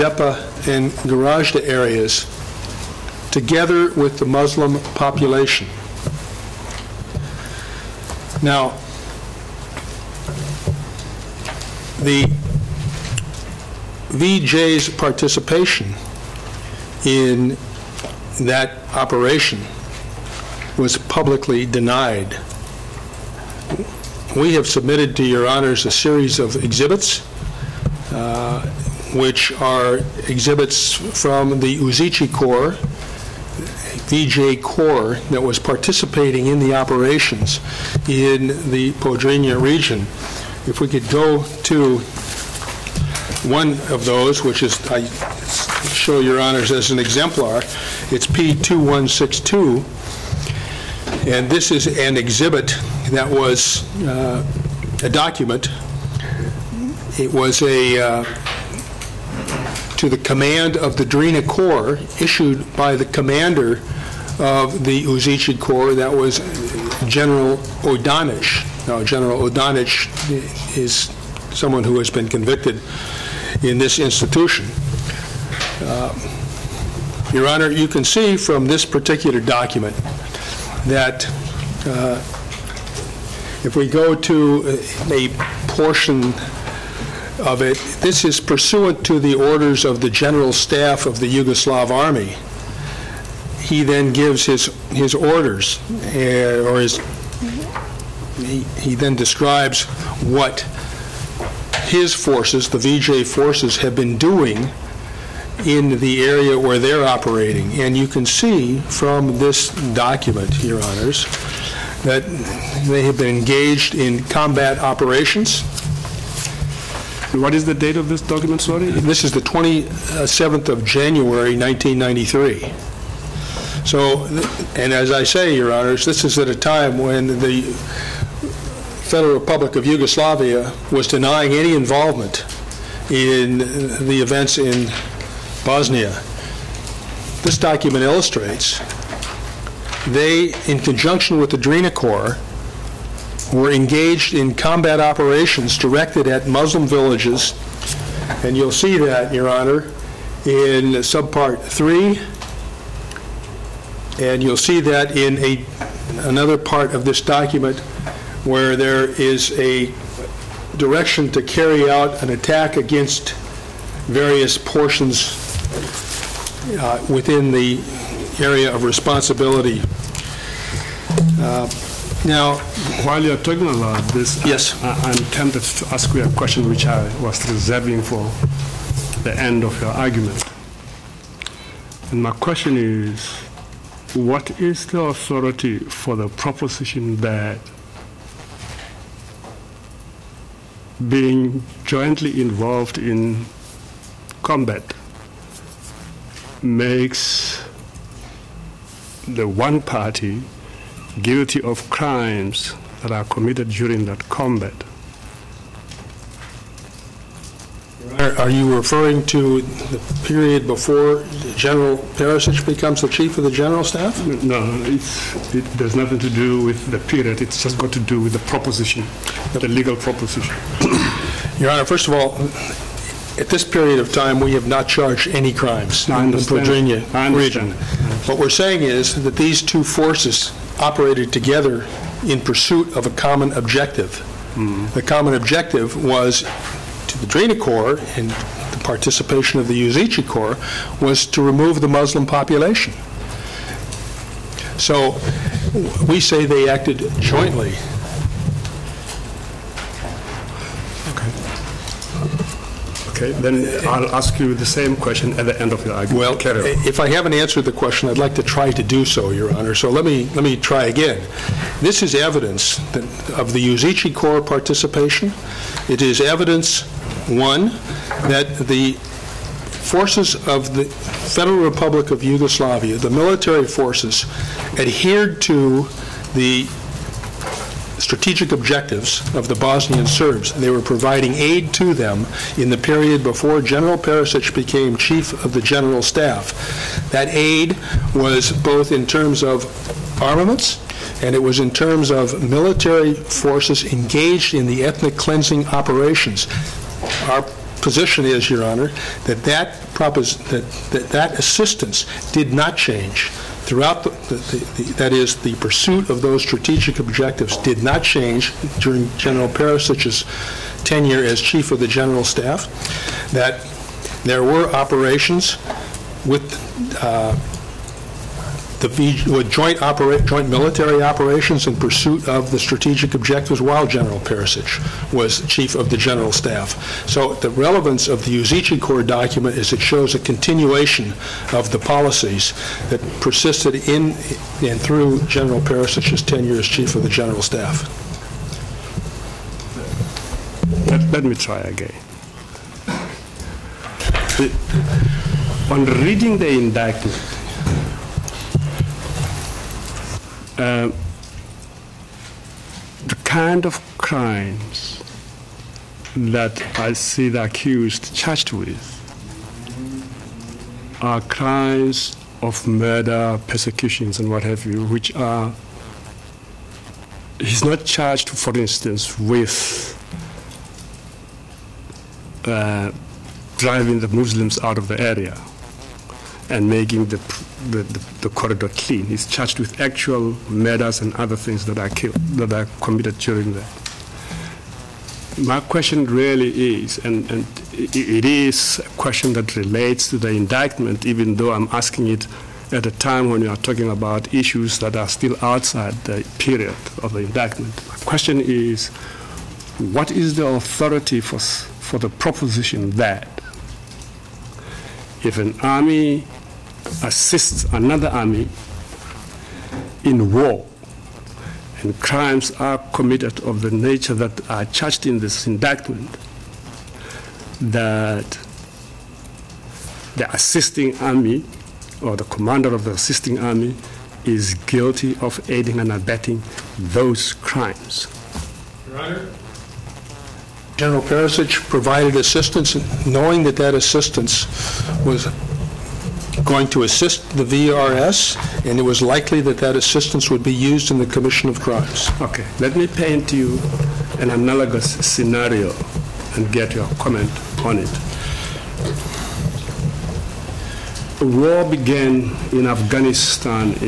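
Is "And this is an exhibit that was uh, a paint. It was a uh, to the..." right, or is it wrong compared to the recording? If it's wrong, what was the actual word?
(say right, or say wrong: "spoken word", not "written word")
wrong: "document", not "paint".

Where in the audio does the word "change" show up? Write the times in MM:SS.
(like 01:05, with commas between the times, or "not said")
05:02, 05:08.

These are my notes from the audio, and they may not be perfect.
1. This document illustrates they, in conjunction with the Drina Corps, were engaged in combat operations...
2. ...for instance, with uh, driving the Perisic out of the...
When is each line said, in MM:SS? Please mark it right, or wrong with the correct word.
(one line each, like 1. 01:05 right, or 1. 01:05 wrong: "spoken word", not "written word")
1. 02:17 right
2. 06:08 wrong: "Muslims", not "Perisic".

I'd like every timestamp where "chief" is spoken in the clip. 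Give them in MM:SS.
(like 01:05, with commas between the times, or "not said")
03:33, 04:44, 05:11, 05:25, 05:36.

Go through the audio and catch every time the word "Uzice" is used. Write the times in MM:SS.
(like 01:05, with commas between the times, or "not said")
00:31, 01:05, 03:59, 04:23, 05:28.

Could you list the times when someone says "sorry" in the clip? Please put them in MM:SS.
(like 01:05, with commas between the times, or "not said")
01:58.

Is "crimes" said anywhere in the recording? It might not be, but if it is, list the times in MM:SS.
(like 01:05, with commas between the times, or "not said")
03:21, 03:45, 05:53, 06:01, 06:51, 07:07, 07:21.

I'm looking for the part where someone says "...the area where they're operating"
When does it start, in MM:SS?
01:45.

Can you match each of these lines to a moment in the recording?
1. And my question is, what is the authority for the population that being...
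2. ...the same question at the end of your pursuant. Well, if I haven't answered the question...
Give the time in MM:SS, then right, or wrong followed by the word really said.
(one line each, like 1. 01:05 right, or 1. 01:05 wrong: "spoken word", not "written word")
1. 03:02 wrong: "proposition", not "population"
2. 04:14 wrong: "argument", not "pursuant".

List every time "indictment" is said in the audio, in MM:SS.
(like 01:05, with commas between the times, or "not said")
05:46, 06:30, 06:37, 06:55.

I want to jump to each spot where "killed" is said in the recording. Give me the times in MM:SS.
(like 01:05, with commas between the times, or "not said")
06:21.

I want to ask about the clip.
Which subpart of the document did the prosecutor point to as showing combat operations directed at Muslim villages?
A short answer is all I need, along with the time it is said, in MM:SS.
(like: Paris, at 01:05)
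3, at 02:31.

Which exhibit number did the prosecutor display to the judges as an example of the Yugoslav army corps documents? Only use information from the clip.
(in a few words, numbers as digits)
P2162.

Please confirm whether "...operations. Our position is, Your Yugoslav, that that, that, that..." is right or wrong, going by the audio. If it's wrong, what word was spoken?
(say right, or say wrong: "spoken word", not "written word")
wrong: "Honor", not "Yugoslav".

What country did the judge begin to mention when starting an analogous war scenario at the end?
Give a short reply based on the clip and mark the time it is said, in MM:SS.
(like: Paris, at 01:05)
Afghanistan, at 07:32.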